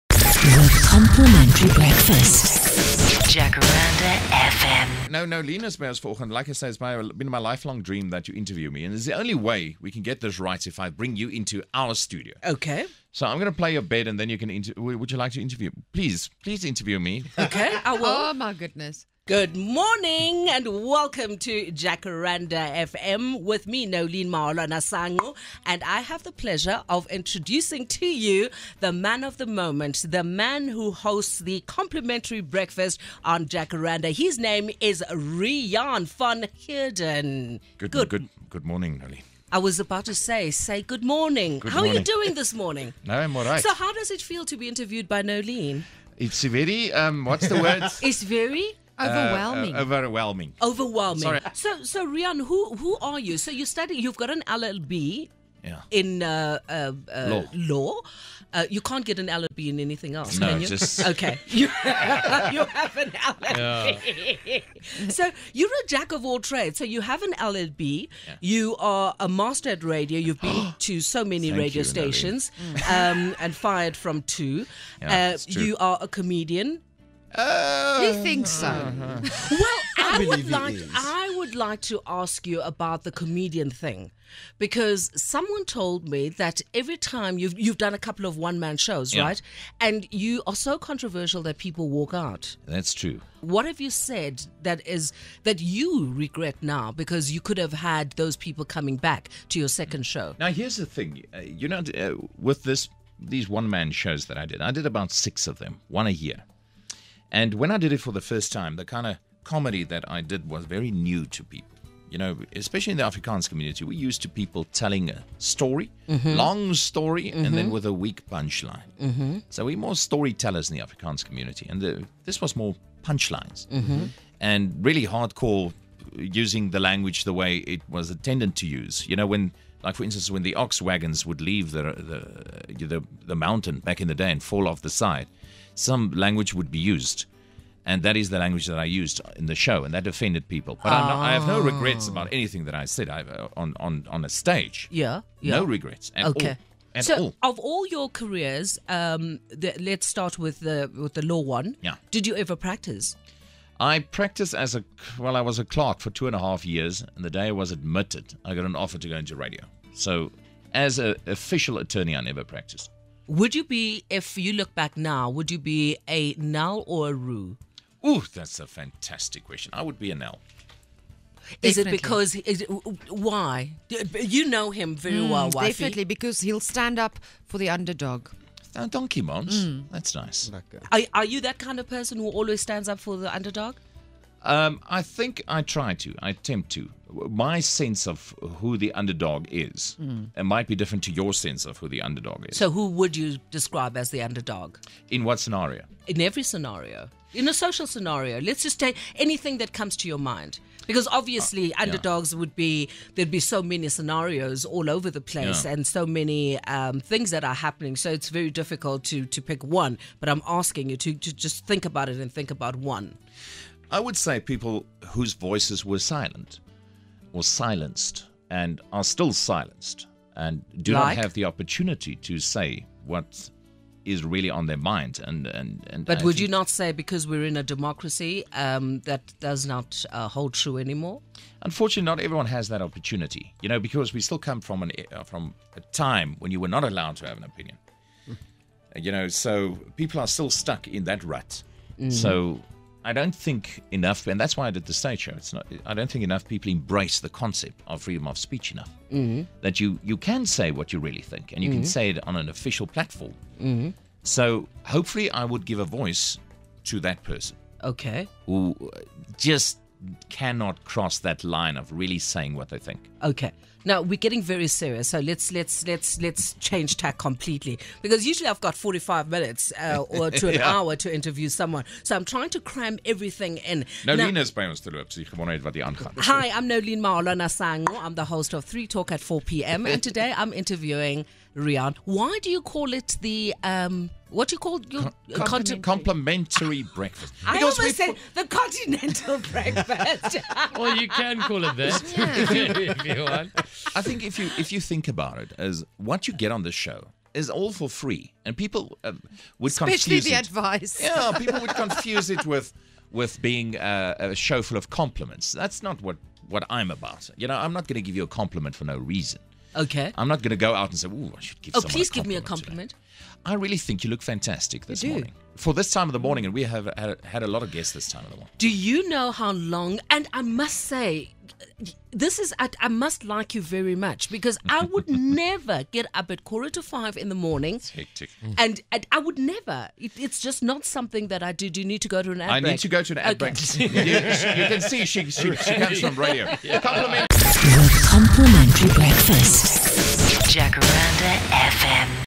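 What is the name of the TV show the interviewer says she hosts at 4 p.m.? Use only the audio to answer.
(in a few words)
3 Talk.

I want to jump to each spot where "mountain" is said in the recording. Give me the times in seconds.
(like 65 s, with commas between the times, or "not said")
133 s.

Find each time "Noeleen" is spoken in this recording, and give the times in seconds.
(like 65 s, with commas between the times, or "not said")
23 s, 39 s, 276 s.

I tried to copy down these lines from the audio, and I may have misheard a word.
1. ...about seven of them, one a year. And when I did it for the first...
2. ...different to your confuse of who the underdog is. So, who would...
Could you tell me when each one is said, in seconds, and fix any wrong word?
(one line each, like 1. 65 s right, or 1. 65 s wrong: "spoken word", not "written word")
1. 104 s wrong: "six", not "seven"
2. 190 s wrong: "sense", not "confuse".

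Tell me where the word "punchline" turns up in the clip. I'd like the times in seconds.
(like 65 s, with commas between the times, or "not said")
118 s, 123 s.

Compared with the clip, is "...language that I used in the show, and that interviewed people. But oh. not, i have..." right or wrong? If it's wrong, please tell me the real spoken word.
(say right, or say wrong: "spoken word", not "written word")
wrong: "offended", not "interviewed".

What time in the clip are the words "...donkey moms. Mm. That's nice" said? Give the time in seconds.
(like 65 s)
178 s.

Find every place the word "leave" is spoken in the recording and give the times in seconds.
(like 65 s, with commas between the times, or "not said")
131 s.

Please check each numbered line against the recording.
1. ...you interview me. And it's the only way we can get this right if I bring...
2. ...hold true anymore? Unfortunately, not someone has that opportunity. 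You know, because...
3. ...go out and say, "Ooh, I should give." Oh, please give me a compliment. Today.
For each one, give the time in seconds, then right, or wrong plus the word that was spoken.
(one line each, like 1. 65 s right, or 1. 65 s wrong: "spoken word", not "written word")
1. 8 s right
2. 230 s wrong: "everyone", not "someone"
3. 310 s right.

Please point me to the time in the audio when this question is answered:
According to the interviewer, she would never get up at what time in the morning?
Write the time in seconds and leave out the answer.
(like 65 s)
326 s.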